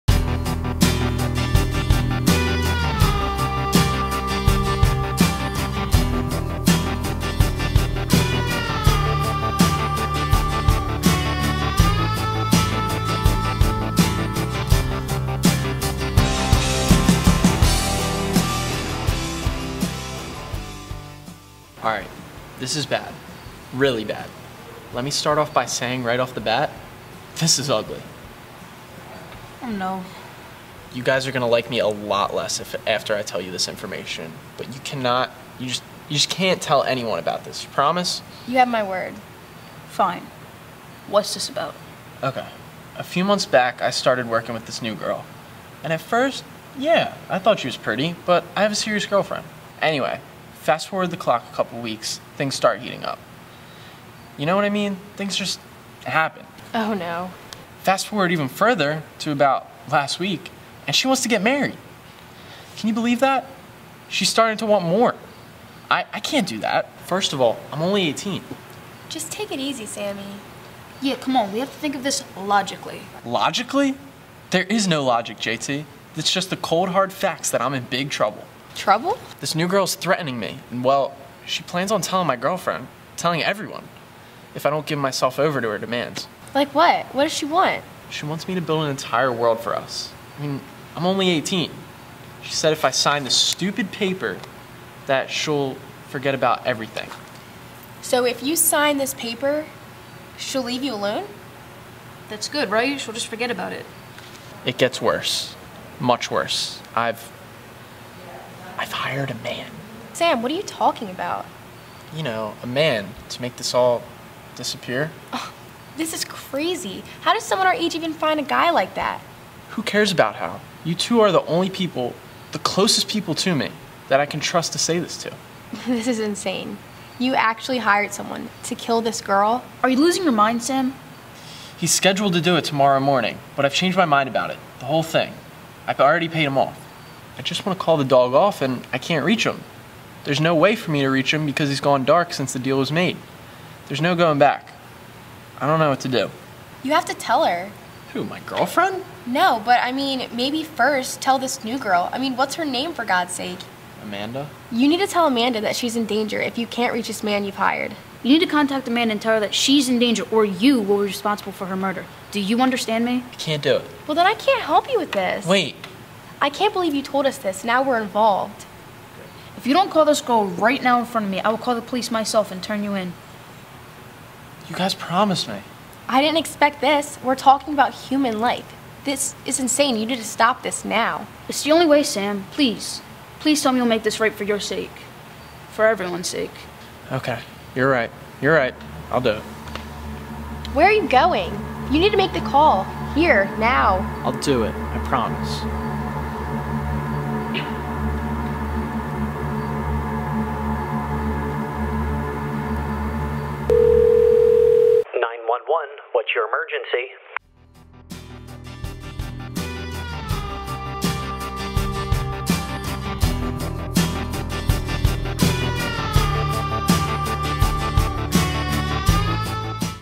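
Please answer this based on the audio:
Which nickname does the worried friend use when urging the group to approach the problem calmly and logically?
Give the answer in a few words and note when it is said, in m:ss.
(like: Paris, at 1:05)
JT, at 1:15.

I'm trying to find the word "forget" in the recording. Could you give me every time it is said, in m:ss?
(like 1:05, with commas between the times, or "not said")
1:36, 1:43.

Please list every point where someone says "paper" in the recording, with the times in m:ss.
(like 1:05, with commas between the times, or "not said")
1:33, 1:39.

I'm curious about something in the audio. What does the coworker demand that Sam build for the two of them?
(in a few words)
An entire world.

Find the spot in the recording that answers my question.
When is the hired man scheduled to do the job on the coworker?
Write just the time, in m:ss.
2:12.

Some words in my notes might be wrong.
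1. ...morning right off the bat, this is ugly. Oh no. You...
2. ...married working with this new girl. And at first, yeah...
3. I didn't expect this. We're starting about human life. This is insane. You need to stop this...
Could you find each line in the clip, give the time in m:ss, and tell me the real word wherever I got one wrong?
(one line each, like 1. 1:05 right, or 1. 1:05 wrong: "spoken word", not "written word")
1. 0:25 wrong: "saying", not "morning"
2. 0:43 wrong: "started", not "married"
3. 2:56 wrong: "talking", not "starting".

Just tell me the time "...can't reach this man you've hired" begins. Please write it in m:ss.
2:36.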